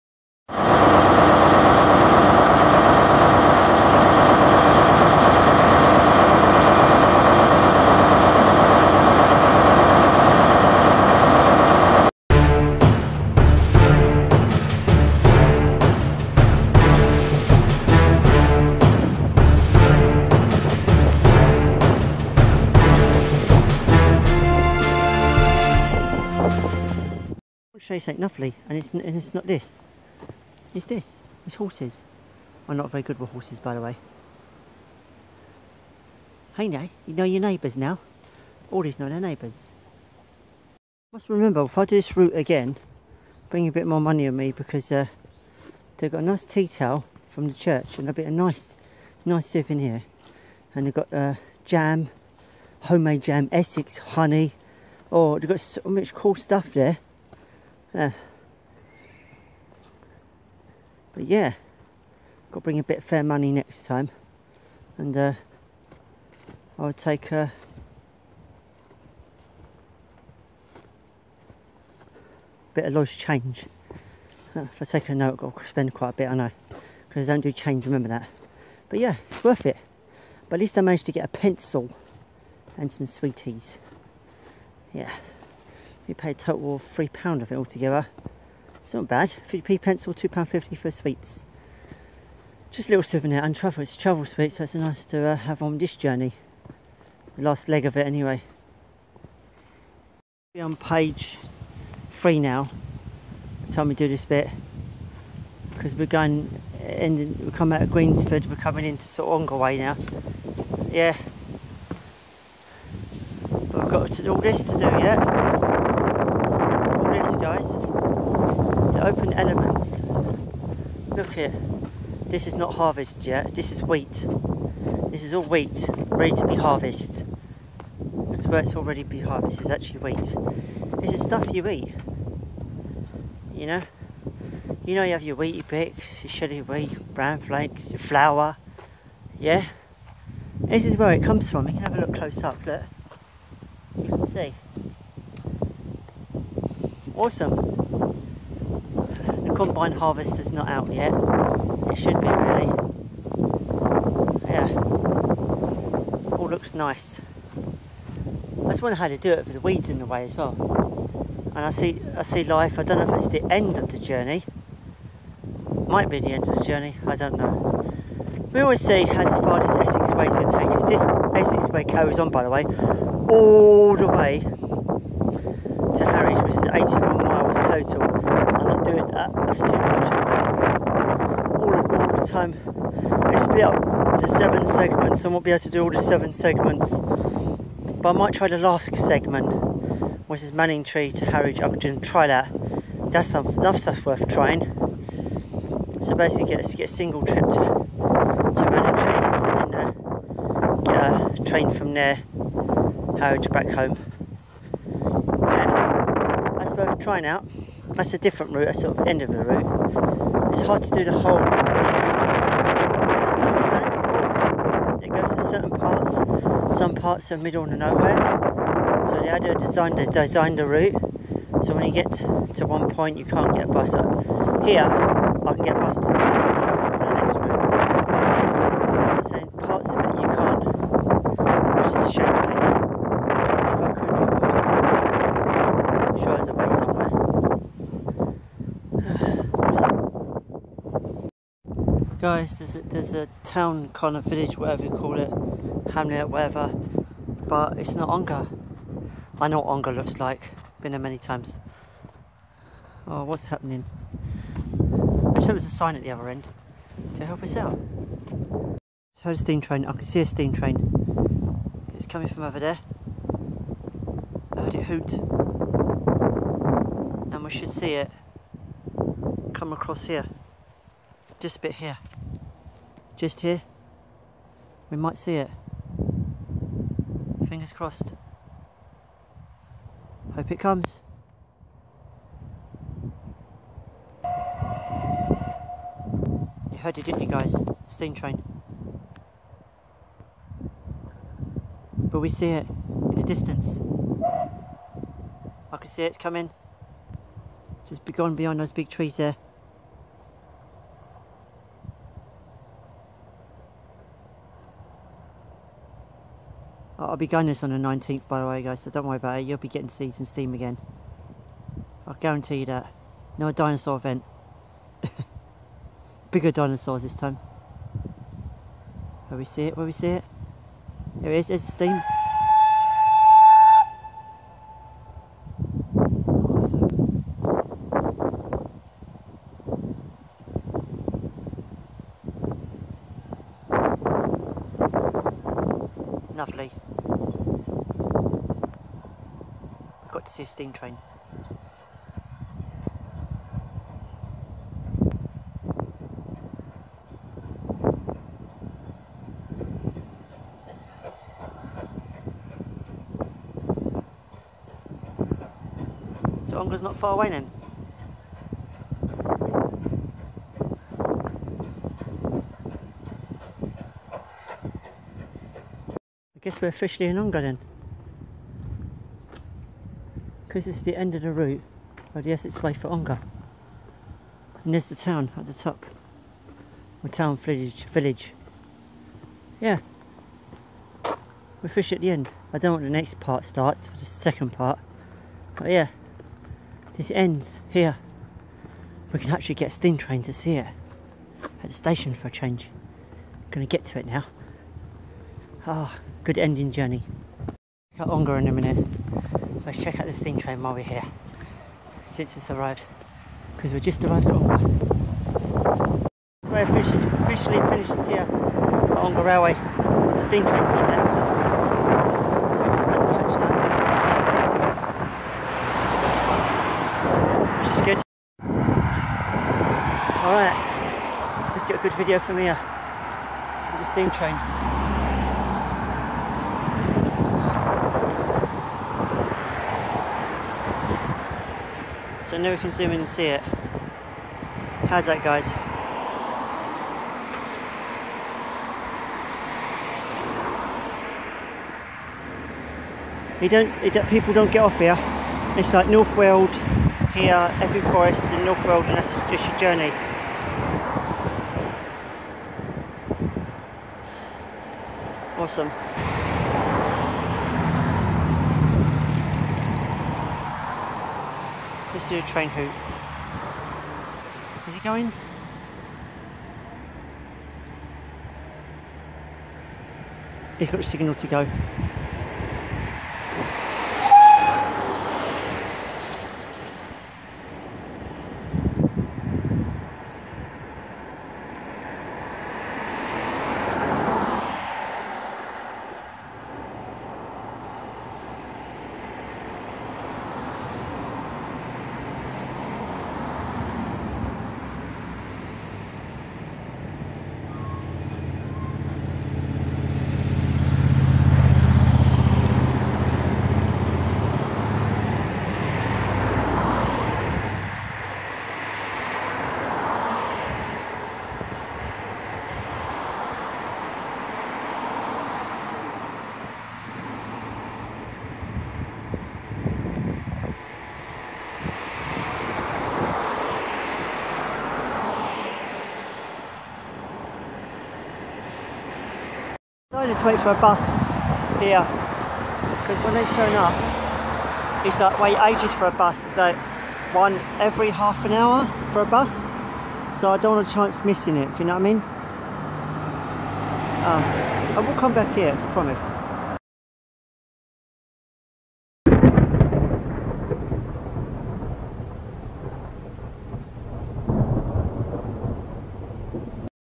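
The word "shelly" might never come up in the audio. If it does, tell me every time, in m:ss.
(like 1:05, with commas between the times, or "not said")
2:16.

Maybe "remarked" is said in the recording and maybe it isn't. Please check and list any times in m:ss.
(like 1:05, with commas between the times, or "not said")
not said.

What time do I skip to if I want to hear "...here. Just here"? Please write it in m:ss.
4:31.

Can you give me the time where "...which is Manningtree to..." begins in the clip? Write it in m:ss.
3:10.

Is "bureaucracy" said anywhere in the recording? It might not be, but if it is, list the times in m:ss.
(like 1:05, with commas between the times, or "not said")
not said.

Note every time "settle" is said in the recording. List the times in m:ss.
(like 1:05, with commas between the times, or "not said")
not said.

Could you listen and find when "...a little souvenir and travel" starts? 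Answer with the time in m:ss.
1:32.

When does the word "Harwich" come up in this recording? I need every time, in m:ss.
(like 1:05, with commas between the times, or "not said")
3:11, 3:23.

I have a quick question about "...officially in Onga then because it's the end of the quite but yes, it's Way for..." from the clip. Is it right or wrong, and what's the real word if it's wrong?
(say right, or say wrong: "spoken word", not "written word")
wrong: "route", not "quite".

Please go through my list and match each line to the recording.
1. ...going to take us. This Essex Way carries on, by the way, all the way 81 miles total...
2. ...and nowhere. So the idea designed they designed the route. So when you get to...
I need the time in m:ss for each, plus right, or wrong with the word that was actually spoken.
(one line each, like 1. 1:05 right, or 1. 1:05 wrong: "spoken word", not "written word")
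1. 2:50 right
2. 3:37 right.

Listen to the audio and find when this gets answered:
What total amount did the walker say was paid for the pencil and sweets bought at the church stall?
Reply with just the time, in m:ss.
1:26.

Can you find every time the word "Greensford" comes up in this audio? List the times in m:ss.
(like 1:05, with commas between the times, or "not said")
1:47.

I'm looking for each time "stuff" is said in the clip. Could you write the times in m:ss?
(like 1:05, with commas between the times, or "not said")
0:56, 2:11, 3:13.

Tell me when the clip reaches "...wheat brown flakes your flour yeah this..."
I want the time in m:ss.
2:16.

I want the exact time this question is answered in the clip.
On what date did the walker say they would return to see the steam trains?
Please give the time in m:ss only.
5:07.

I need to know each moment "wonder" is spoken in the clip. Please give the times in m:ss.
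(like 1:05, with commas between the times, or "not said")
2:38.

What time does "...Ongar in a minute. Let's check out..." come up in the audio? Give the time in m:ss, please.
6:38.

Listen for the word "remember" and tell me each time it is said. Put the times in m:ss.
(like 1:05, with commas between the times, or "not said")
0:41, 1:17.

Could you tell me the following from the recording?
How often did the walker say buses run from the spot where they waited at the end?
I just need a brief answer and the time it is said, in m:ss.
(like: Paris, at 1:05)
every half an hour, at 8:57.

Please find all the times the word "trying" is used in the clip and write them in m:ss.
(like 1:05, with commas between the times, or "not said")
3:14, 3:27.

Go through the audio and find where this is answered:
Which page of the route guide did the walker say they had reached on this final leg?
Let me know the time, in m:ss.
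1:40.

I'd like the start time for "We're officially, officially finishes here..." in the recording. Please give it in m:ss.
6:46.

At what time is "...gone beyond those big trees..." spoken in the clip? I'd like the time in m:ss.
4:58.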